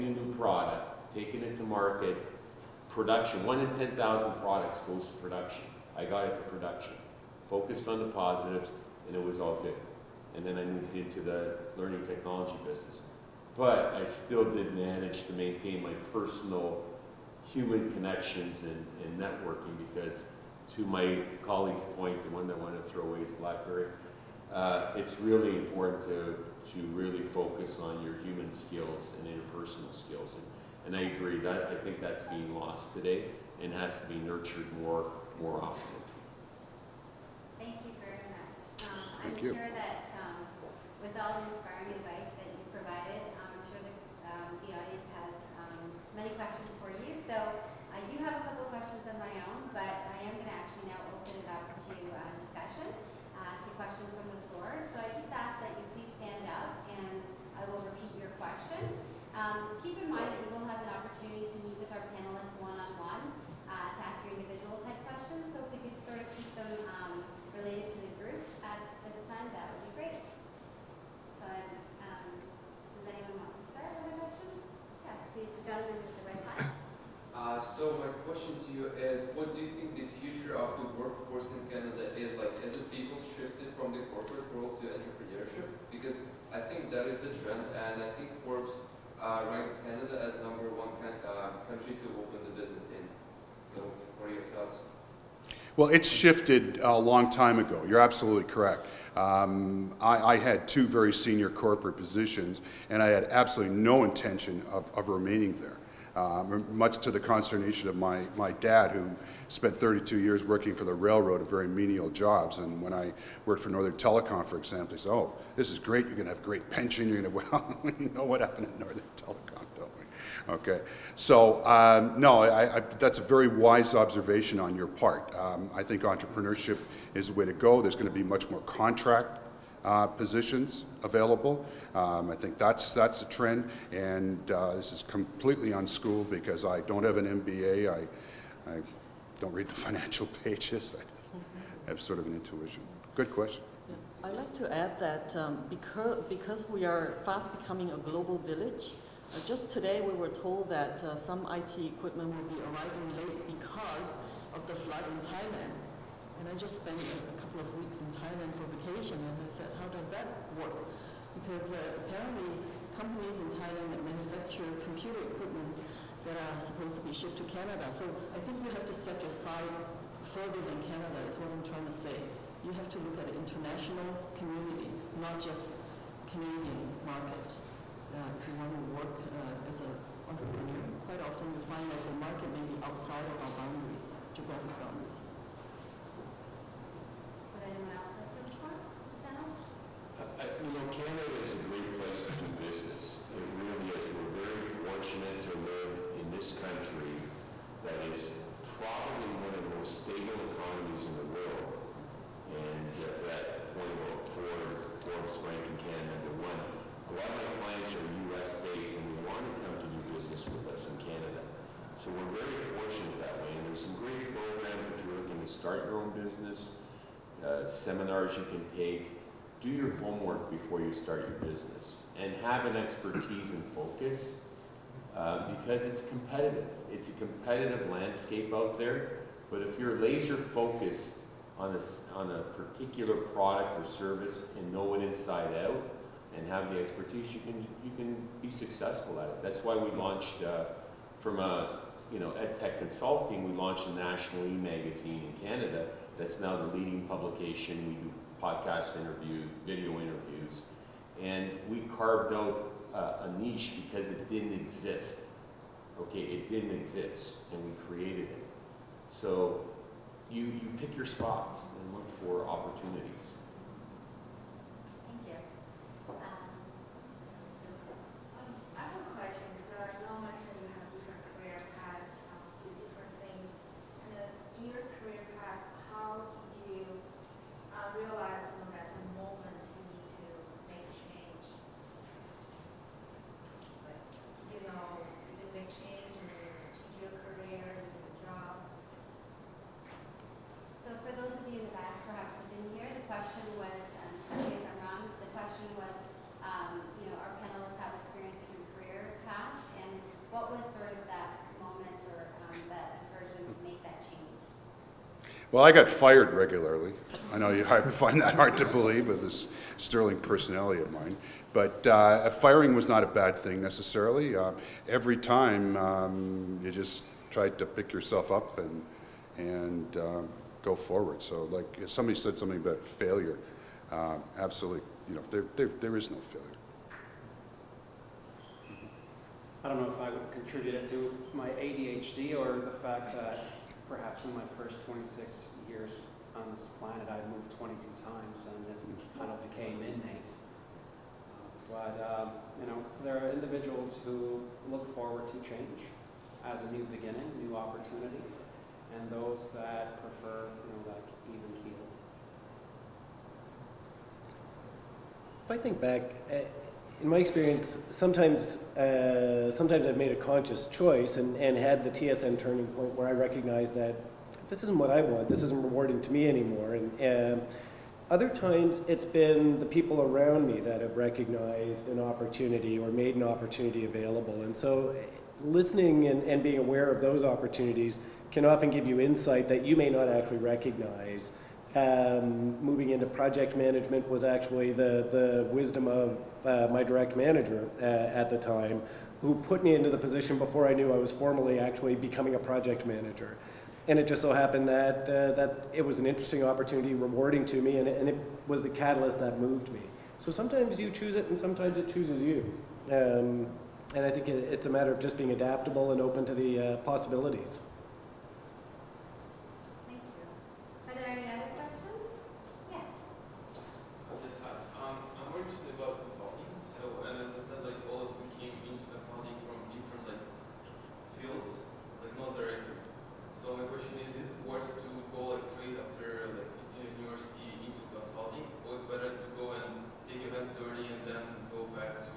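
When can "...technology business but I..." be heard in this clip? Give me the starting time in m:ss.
0:12.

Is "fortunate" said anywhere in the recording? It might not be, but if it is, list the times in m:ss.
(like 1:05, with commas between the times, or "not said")
3:14, 3:32.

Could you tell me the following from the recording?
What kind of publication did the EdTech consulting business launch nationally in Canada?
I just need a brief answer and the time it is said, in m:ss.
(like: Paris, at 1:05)
e-magazine, at 4:03.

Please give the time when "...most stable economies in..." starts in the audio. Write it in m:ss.
3:19.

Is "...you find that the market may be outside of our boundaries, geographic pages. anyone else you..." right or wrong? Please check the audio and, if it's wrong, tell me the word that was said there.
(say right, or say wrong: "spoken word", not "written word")
wrong: "boundaries", not "pages".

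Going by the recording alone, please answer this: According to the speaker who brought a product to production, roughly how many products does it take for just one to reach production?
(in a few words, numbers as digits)
10,000.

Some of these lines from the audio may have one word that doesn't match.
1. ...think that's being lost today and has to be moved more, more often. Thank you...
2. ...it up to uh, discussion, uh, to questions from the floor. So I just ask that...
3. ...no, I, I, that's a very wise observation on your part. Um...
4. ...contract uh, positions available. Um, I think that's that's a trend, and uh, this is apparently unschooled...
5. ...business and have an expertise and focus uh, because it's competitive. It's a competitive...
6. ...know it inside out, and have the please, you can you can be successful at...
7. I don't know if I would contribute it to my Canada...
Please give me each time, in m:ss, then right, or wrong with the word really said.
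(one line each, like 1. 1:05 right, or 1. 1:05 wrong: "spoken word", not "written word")
1. 0:31 wrong: "nurtured", not "moved"
2. 0:51 right
3. 2:02 right
4. 2:08 wrong: "completely", not "apparently"
5. 3:41 right
6. 3:54 wrong: "expertise", not "please"
7. 5:29 wrong: "ADHD", not "Canada".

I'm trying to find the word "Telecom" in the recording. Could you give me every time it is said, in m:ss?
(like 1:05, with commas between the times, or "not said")
1:53, 1:59.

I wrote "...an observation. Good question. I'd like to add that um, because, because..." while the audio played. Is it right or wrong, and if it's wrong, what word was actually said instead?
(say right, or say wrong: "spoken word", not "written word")
wrong: "intuition", not "observation".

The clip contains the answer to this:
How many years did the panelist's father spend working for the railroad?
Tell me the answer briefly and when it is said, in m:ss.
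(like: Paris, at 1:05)
32, at 1:49.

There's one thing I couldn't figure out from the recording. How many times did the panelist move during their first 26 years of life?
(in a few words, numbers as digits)
22.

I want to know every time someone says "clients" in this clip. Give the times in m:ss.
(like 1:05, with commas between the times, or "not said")
3:27.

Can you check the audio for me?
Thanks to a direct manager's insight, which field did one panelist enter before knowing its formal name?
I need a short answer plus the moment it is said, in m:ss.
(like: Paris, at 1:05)
project management, at 6:23.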